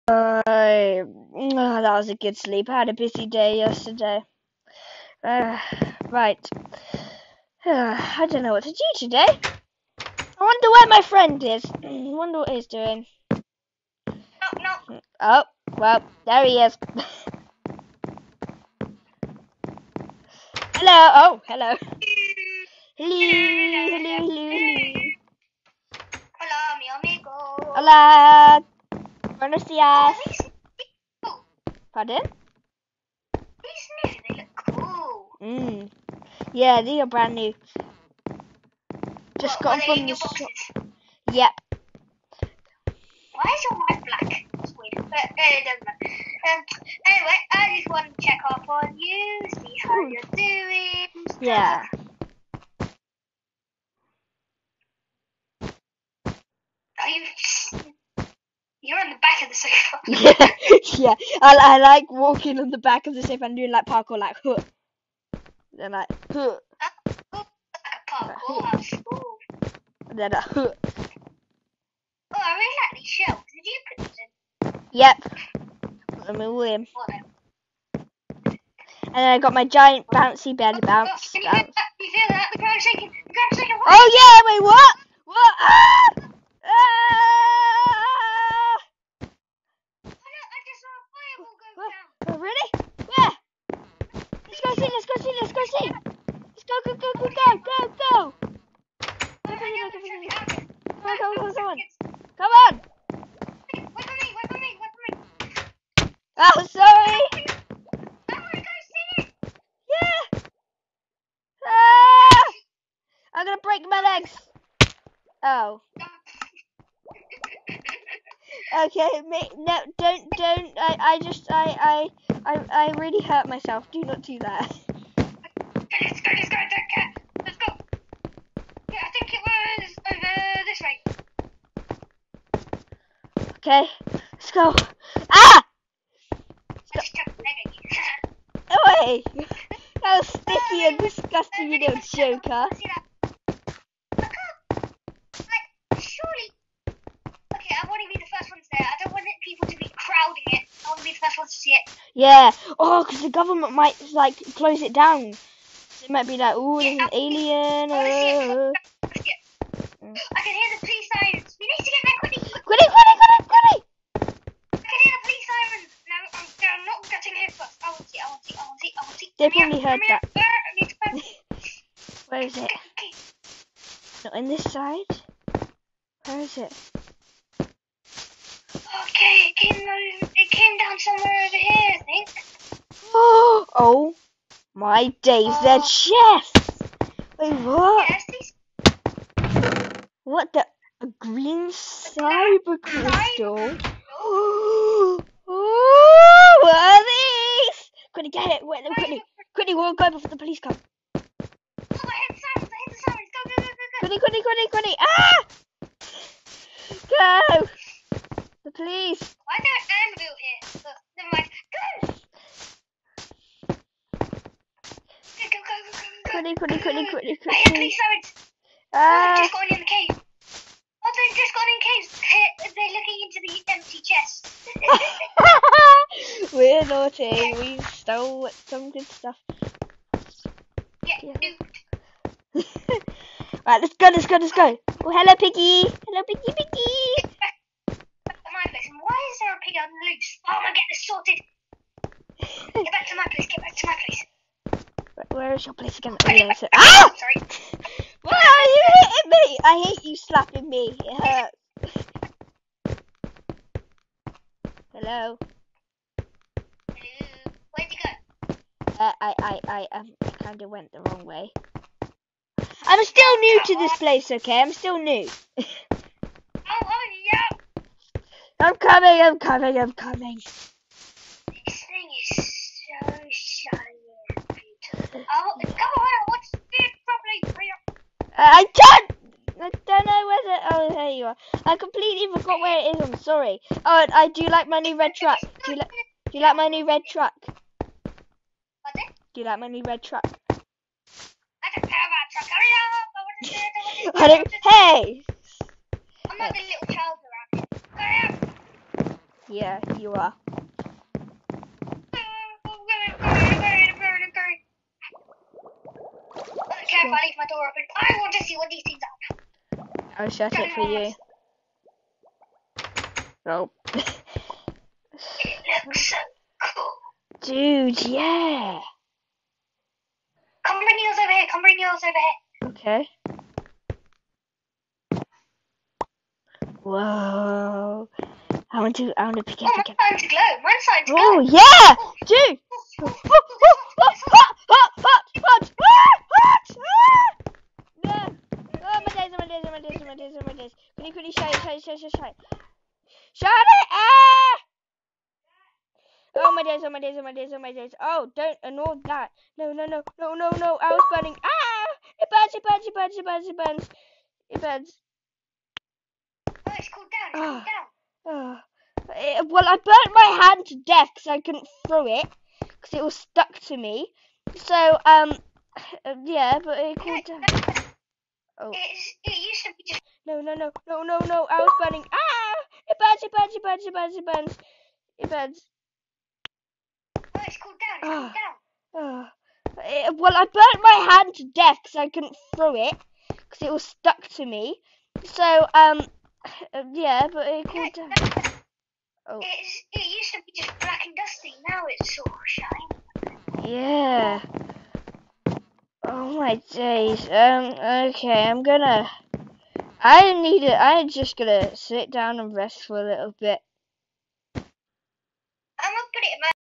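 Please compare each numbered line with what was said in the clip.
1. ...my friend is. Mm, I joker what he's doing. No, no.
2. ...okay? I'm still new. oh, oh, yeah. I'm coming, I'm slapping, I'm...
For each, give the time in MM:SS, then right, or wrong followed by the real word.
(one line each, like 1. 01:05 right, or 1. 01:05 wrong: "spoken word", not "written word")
1. 00:10 wrong: "wonder", not "joker"
2. 04:24 wrong: "coming", not "slapping".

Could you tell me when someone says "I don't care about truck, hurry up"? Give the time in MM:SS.
04:50.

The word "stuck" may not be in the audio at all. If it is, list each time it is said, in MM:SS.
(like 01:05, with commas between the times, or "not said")
06:03, 06:23.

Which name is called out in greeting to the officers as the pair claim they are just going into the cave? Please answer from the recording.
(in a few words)
Anthony.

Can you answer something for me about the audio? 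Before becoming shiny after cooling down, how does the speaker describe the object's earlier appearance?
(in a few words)
black and dusty.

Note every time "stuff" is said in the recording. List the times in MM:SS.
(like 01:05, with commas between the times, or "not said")
03:49.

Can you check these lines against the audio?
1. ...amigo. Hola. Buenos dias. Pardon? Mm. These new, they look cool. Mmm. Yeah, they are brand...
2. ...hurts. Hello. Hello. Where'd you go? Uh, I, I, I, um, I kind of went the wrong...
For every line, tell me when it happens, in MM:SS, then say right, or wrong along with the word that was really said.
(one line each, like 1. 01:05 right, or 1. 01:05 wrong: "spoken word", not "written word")
1. 00:26 right
2. 04:11 right.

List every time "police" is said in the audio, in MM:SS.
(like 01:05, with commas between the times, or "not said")
02:40, 02:45, 03:20, 03:28.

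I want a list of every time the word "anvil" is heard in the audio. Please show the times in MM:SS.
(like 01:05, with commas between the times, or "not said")
03:30.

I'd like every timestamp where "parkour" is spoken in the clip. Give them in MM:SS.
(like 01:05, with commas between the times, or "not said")
01:03, 01:08.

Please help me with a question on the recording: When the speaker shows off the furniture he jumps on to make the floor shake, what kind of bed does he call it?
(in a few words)
giant bouncy bed.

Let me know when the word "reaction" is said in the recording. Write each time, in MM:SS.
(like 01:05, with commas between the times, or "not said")
not said.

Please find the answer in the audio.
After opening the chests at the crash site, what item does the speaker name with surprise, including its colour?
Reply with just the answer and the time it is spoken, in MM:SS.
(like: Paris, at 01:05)
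green cyber crystal, at 03:11.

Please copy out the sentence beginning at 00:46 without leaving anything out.
Um, anyway, I just want to check up on you, see how Ooh.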